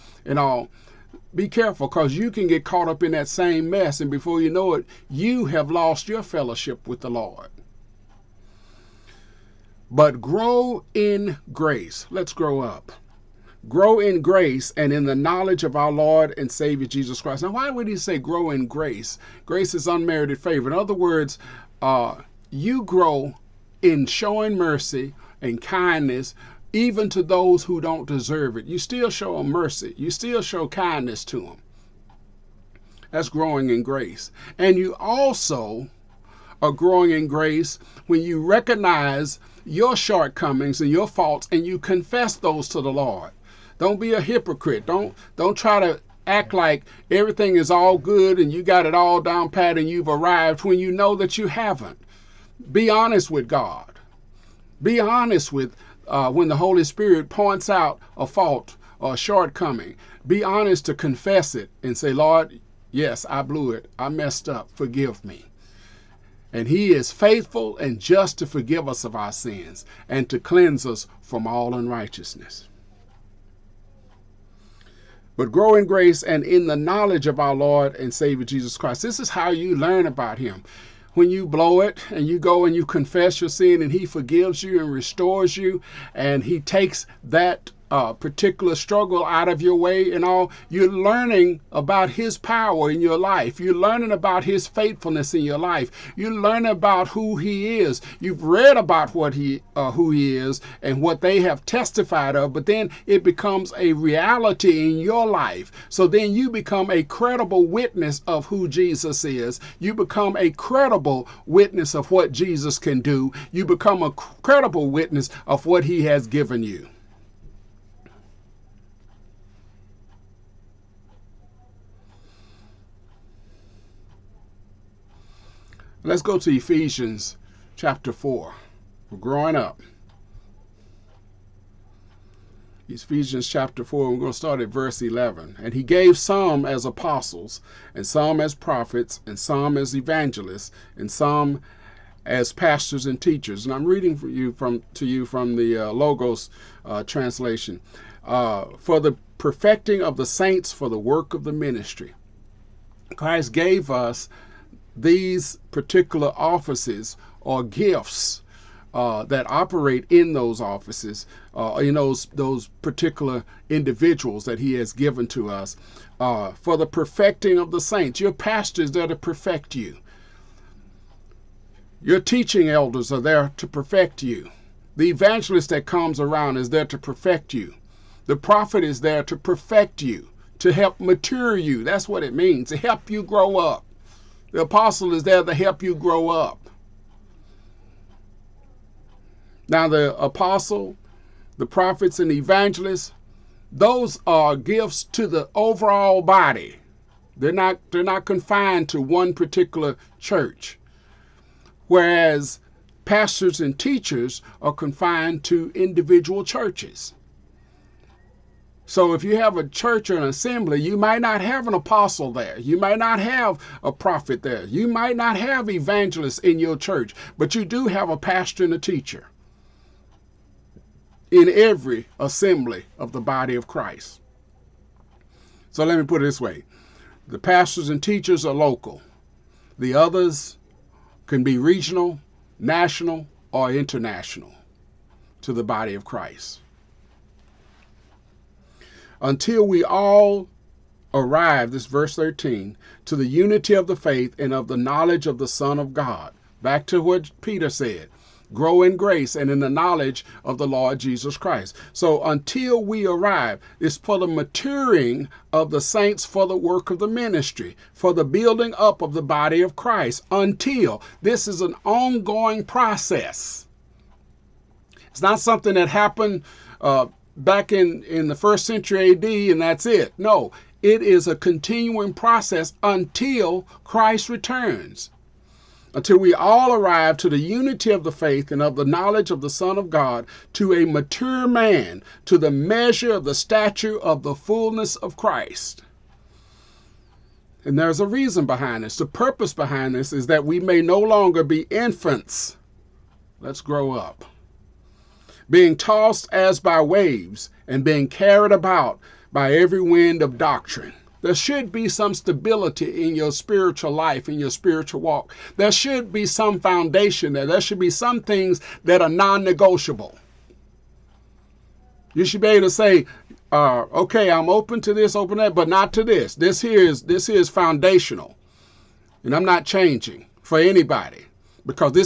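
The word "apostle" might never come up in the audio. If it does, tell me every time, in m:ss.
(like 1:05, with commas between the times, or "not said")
2:16, 3:04, 3:10, 3:31.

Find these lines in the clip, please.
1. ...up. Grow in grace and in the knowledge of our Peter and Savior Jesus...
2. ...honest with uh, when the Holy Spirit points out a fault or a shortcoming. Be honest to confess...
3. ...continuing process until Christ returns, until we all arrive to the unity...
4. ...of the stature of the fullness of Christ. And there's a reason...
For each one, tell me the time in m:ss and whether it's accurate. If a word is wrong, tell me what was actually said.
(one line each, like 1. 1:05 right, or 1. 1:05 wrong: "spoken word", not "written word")
1. 0:12 wrong: "Lord", not "Peter"
2. 0:54 right
3. 4:31 right
4. 4:43 right.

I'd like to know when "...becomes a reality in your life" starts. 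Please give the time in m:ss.
1:43.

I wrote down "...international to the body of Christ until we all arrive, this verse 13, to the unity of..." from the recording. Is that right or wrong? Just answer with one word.
right.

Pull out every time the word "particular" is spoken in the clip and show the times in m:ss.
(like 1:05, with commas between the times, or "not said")
1:28, 2:35, 2:42, 3:19.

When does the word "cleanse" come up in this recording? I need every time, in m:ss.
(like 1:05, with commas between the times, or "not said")
1:10.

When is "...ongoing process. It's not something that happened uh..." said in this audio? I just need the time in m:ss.
4:21.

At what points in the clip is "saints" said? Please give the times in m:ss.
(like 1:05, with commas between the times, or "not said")
2:30, 2:47, 4:15.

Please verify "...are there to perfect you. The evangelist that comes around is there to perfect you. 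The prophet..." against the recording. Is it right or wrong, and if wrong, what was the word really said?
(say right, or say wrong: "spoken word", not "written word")
right.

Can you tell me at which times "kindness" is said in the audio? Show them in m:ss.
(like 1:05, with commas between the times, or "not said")
0:25, 0:30.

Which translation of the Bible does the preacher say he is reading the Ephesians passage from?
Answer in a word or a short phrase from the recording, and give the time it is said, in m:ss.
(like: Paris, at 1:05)
Logos, at 2:25.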